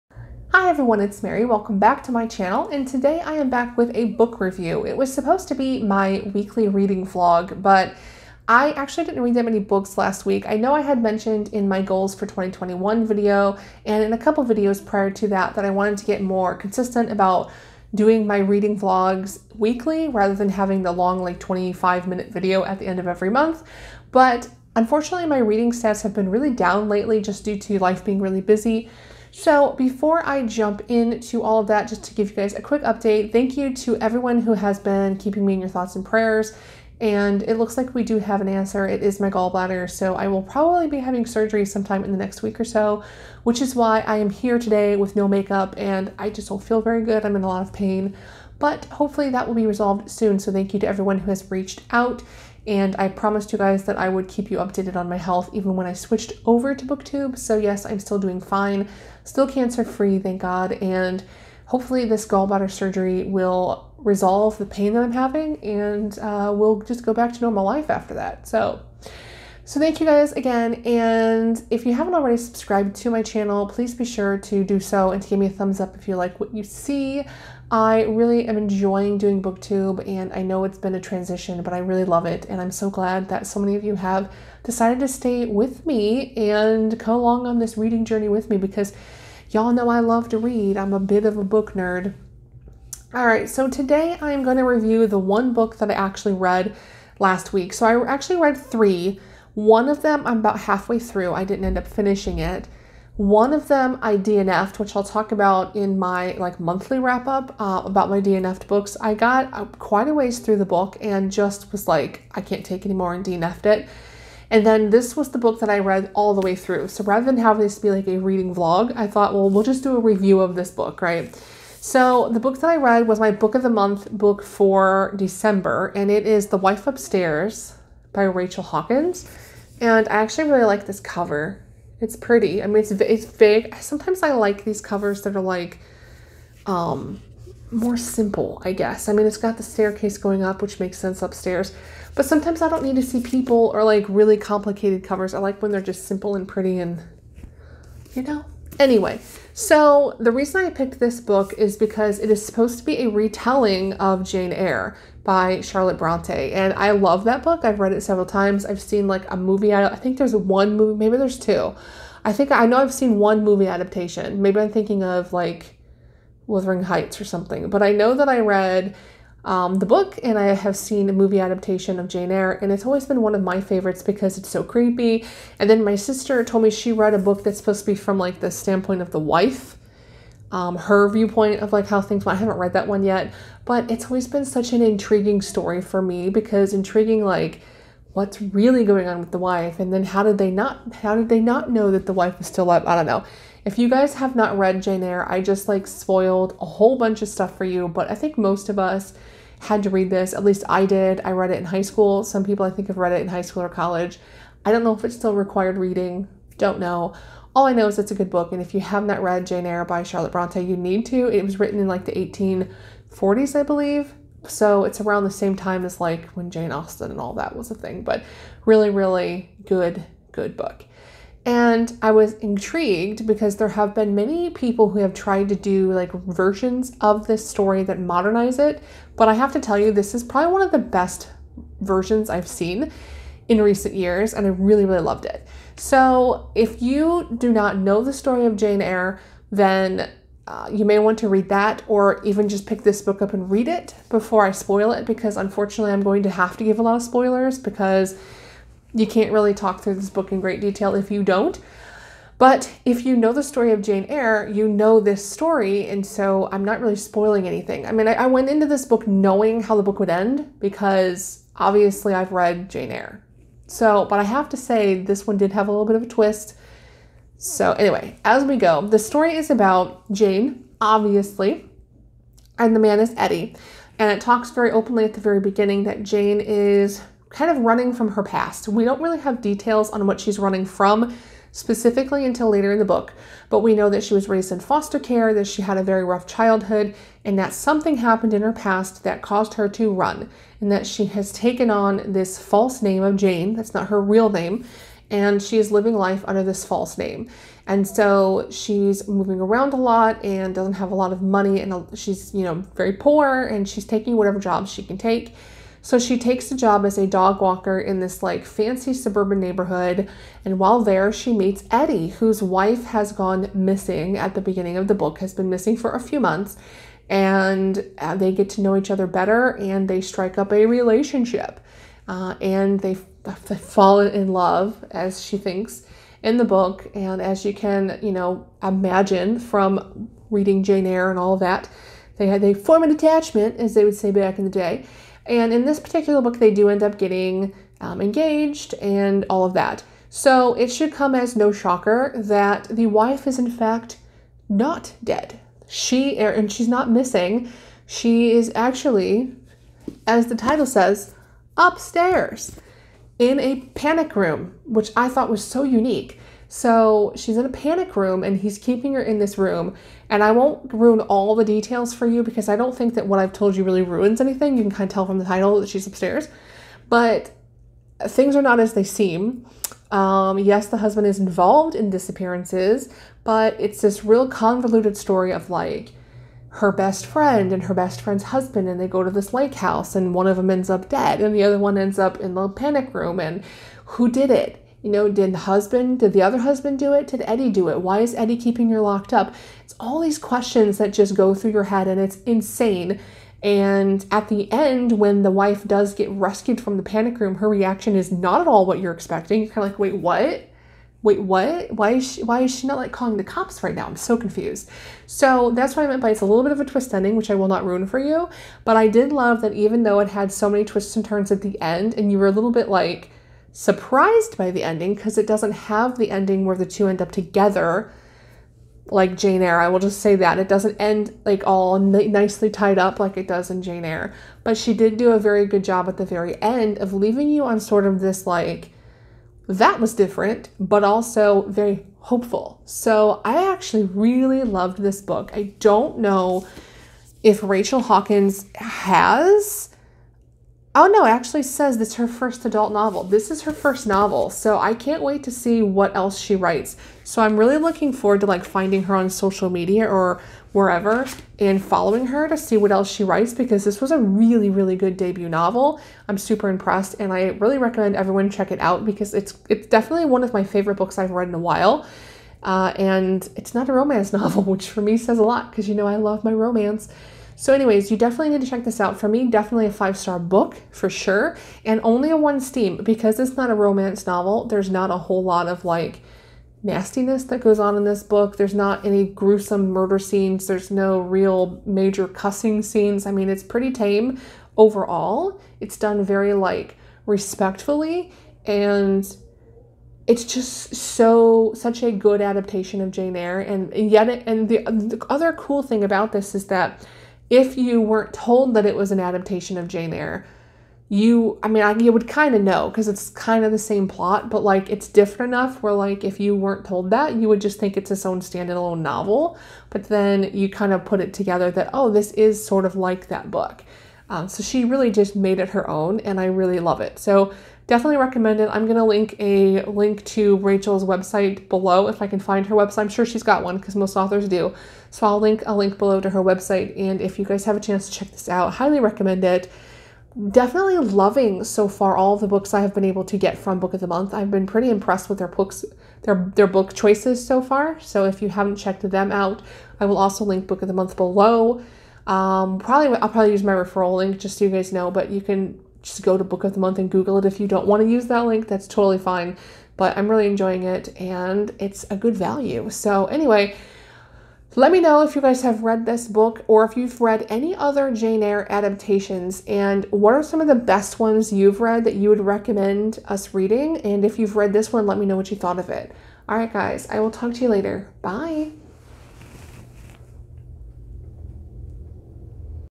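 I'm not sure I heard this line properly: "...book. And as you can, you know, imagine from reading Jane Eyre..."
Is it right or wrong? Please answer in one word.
right.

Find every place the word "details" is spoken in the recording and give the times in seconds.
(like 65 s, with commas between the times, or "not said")
250 s, 279 s, 361 s.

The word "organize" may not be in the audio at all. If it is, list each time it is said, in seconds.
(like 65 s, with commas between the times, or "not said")
not said.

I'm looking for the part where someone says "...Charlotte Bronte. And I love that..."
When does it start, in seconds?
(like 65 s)
155 s.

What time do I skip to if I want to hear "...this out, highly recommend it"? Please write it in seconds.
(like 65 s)
528 s.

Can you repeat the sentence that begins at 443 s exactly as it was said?
This is her first novel, so I can't wait to see what else she writes.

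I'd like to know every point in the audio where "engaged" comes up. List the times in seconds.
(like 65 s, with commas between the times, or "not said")
338 s.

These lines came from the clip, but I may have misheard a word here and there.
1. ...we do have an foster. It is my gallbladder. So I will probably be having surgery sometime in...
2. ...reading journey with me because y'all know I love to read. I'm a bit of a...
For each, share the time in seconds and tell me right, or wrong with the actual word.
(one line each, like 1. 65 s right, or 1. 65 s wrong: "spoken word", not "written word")
1. 37 s wrong: "answer", not "foster"
2. 87 s right.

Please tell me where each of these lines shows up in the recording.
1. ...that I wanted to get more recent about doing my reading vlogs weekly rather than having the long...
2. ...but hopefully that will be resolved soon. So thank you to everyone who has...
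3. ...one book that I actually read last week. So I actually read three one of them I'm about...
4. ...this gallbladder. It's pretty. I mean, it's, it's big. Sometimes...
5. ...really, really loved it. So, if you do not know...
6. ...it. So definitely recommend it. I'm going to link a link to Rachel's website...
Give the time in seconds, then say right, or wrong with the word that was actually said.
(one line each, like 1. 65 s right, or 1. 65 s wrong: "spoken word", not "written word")
1. 15 s wrong: "consistent", not "recent"
2. 48 s right
3. 95 s right
4. 130 s wrong: "cover", not "gallbladder"
5. 234 s right
6. 516 s right.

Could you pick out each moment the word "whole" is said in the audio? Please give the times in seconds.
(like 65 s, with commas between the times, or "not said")
196 s, 474 s.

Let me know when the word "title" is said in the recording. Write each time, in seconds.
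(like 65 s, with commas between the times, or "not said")
350 s, 365 s.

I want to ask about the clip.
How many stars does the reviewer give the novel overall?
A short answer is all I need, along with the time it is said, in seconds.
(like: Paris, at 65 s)
5, at 469 s.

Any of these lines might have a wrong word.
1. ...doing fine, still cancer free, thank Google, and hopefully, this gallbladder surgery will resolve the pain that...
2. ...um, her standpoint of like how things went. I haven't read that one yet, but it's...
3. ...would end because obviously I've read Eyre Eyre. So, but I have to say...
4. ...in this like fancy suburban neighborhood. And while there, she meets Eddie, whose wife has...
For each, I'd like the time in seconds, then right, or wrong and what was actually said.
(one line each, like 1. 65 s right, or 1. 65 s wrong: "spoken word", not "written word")
1. 58 s wrong: "God", not "Google"
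2. 180 s wrong: "viewpoint", not "standpoint"
3. 259 s wrong: "Jane", not "Eyre"
4. 307 s right.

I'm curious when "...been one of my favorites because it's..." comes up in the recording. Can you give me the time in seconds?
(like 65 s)
173 s.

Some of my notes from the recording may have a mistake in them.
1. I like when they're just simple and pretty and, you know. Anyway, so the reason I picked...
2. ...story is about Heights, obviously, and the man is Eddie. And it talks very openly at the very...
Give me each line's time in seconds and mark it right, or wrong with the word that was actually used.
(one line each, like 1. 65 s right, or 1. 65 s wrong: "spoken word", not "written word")
1. 145 s right
2. 268 s wrong: "Jane", not "Heights".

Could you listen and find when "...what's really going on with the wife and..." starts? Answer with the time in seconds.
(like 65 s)
188 s.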